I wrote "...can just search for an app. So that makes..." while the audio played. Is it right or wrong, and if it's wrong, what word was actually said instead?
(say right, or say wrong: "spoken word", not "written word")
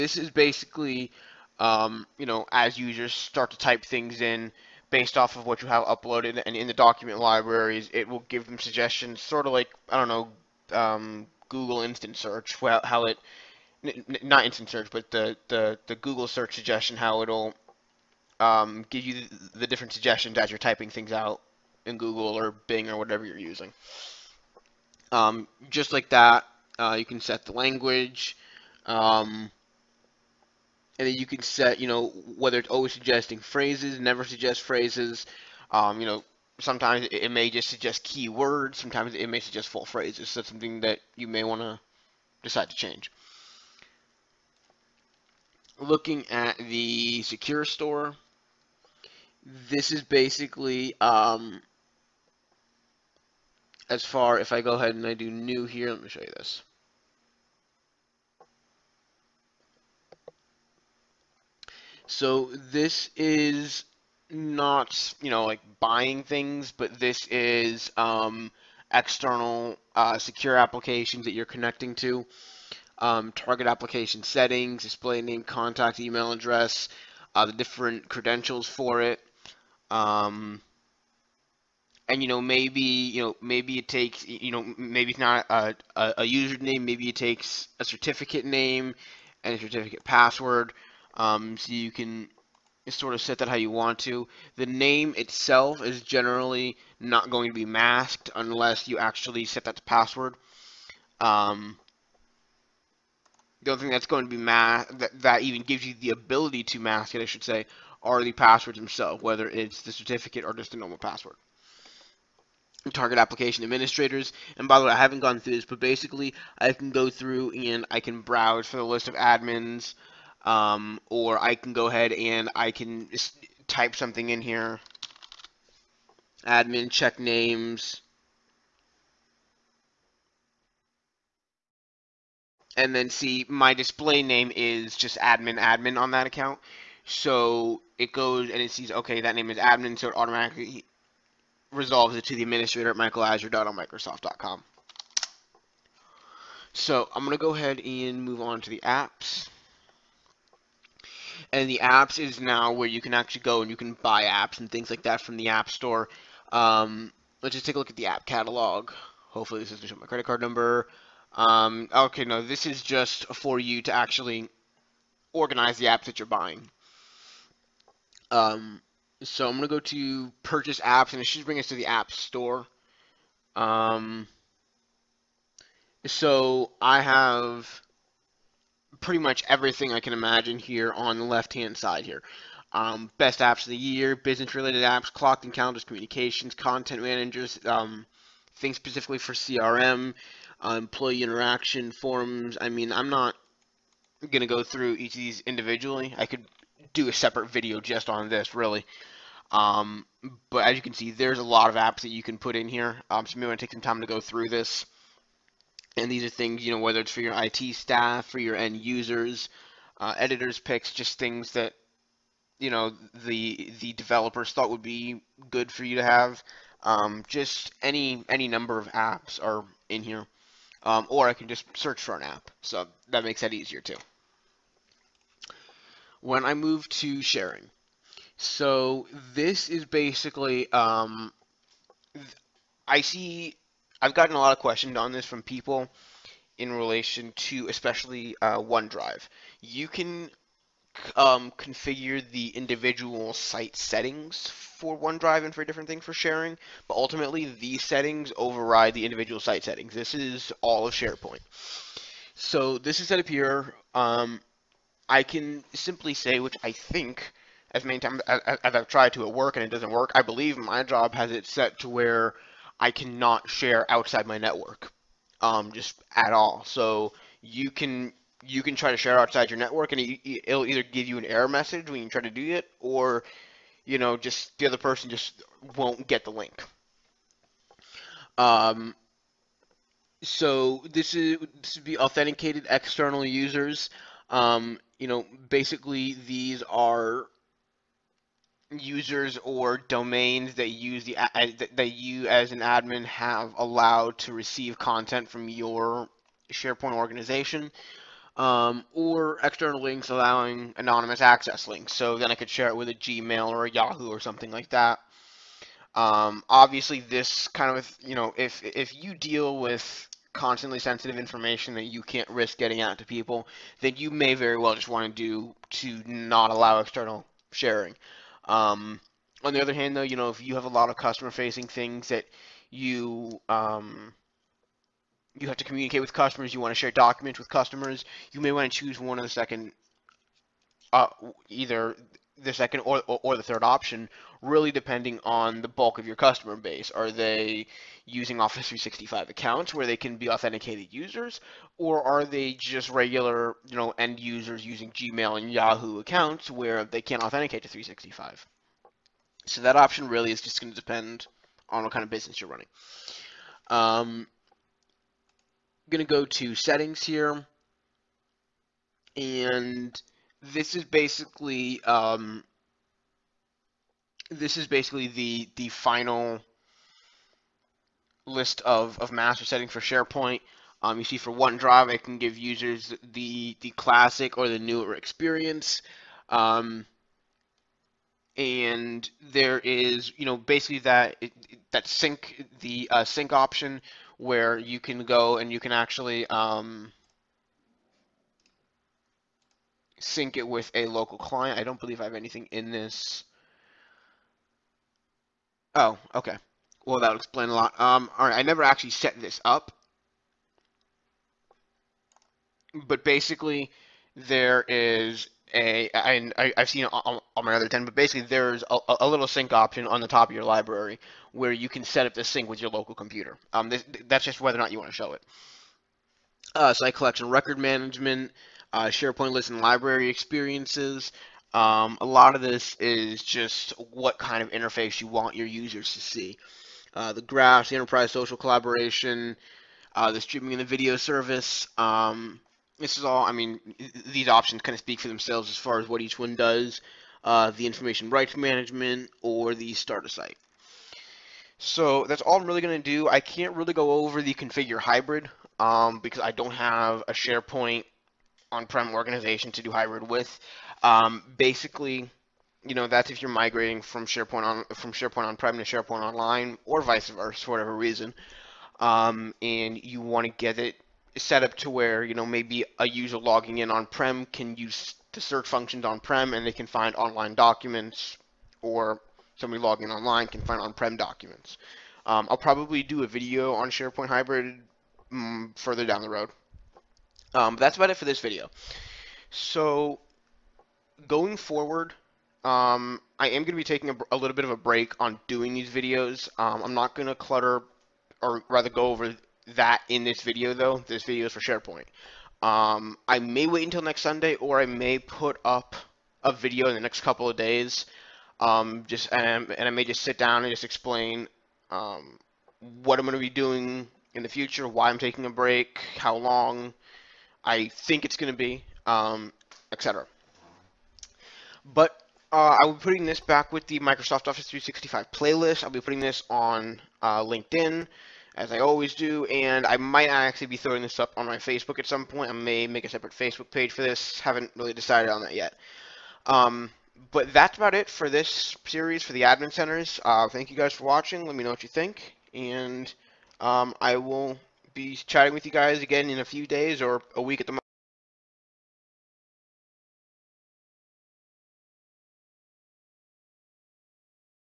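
right.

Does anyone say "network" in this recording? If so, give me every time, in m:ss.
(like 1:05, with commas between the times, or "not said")
4:24, 4:29.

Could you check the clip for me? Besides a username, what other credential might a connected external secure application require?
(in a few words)
certificate name.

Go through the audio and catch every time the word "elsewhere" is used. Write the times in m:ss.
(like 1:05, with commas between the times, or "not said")
not said.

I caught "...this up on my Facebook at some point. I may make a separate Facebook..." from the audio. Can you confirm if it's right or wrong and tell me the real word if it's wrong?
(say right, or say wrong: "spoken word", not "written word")
right.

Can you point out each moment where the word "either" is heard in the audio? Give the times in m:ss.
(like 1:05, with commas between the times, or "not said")
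4:30, 5:31.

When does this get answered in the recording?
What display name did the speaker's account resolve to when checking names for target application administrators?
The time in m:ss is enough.
2:15.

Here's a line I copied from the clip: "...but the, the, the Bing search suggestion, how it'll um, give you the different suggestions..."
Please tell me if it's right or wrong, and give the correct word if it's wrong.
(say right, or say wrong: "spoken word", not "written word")
wrong: "Google", not "Bing".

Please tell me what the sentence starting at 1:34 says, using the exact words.
The name itself is generally not going to be masked unless you actually set that to password.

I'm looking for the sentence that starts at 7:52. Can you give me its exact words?
Um, I'll probably do a video on SharePoint Hybrid mm, further down the road.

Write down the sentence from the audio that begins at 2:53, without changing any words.
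Um, so I have pretty much everything I can imagine here on the left-hand side here.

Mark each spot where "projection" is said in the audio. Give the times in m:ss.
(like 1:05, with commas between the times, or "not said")
not said.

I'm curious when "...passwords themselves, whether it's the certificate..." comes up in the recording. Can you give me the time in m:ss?
1:48.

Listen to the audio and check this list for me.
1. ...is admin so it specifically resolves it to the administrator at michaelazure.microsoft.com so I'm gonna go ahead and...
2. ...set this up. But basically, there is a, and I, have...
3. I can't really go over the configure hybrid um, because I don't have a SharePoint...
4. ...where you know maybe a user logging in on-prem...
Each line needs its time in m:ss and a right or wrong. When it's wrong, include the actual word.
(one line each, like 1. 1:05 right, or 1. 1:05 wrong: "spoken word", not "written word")
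1. 2:19 wrong: "automatically", not "specifically"
2. 6:38 right
3. 7:23 right
4. 7:41 right.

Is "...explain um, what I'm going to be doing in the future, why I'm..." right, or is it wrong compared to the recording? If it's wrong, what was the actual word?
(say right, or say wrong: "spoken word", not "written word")
right.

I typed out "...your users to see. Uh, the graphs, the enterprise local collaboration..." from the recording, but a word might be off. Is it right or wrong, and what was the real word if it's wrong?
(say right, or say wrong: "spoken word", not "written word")
wrong: "social", not "local".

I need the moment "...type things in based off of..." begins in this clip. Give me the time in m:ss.
0:03.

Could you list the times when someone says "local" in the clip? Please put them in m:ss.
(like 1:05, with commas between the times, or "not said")
6:30, 6:52.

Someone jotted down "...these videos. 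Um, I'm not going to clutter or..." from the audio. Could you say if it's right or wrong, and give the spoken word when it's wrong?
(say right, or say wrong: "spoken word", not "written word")
right.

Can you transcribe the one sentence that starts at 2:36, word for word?
Um, let's just take a look at the app catalog.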